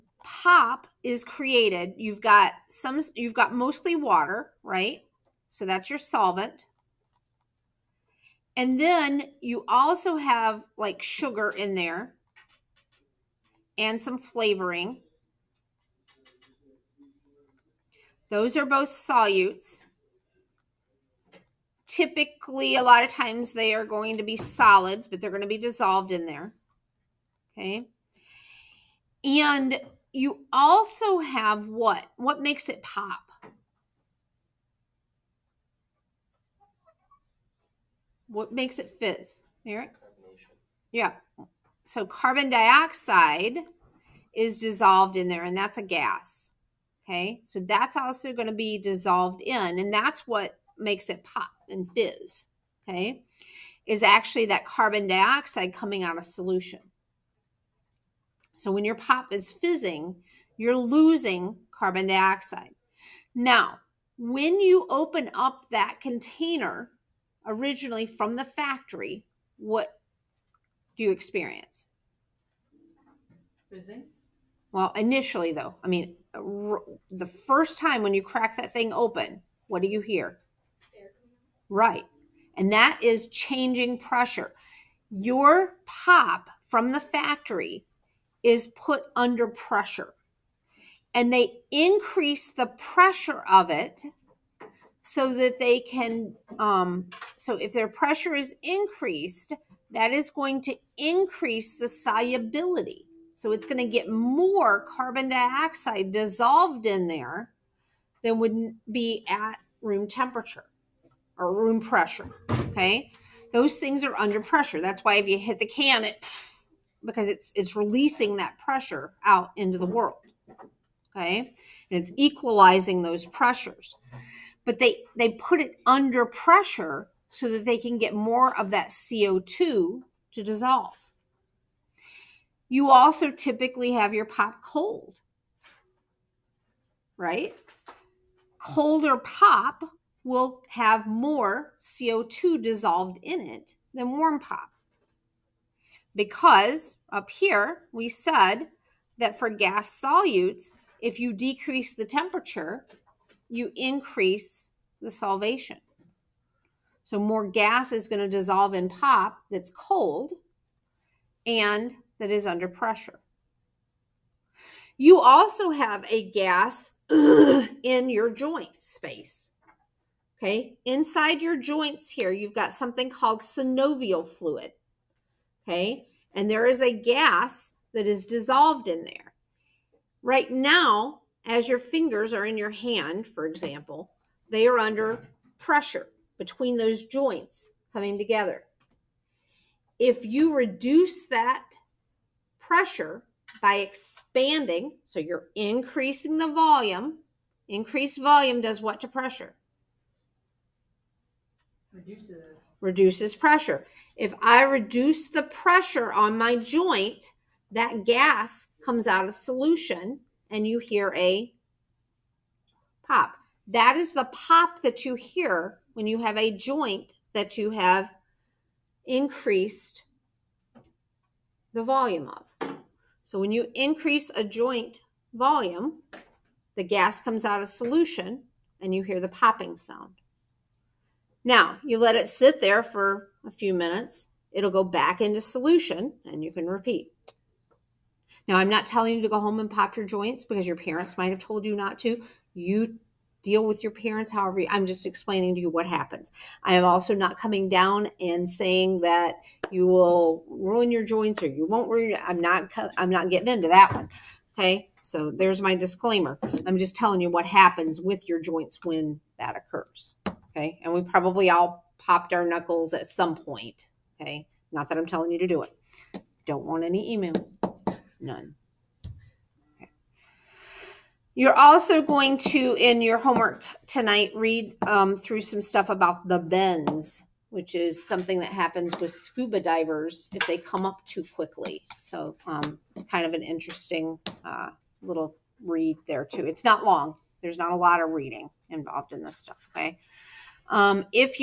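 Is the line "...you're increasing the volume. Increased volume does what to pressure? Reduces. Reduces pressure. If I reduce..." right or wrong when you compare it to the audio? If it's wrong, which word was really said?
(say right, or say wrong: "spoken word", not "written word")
right.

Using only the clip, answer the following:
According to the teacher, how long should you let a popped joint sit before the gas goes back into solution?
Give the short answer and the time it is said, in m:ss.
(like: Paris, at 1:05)
a few minutes, at 3:53.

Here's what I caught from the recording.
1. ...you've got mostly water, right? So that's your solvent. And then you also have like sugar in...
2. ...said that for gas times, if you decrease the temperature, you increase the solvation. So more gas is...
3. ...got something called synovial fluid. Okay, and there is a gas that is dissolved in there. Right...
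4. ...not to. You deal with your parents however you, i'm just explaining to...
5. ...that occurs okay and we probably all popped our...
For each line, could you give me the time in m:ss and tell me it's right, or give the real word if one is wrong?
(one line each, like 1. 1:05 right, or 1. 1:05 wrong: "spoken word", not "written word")
1. 0:03 right
2. 2:28 wrong: "solutes", not "times"
3. 2:52 right
4. 4:01 right
5. 4:19 right.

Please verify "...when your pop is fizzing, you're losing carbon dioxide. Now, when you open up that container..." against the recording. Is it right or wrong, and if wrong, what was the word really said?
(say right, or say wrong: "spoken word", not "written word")
right.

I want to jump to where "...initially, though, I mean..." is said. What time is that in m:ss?
1:14.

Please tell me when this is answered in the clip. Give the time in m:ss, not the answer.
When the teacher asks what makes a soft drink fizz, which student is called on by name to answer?
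0:39.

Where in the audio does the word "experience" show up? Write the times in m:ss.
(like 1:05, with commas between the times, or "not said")
1:11.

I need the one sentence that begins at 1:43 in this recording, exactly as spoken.
So it's going to get more carbon dioxide dissolved in there than would be at room temperature or room pressure.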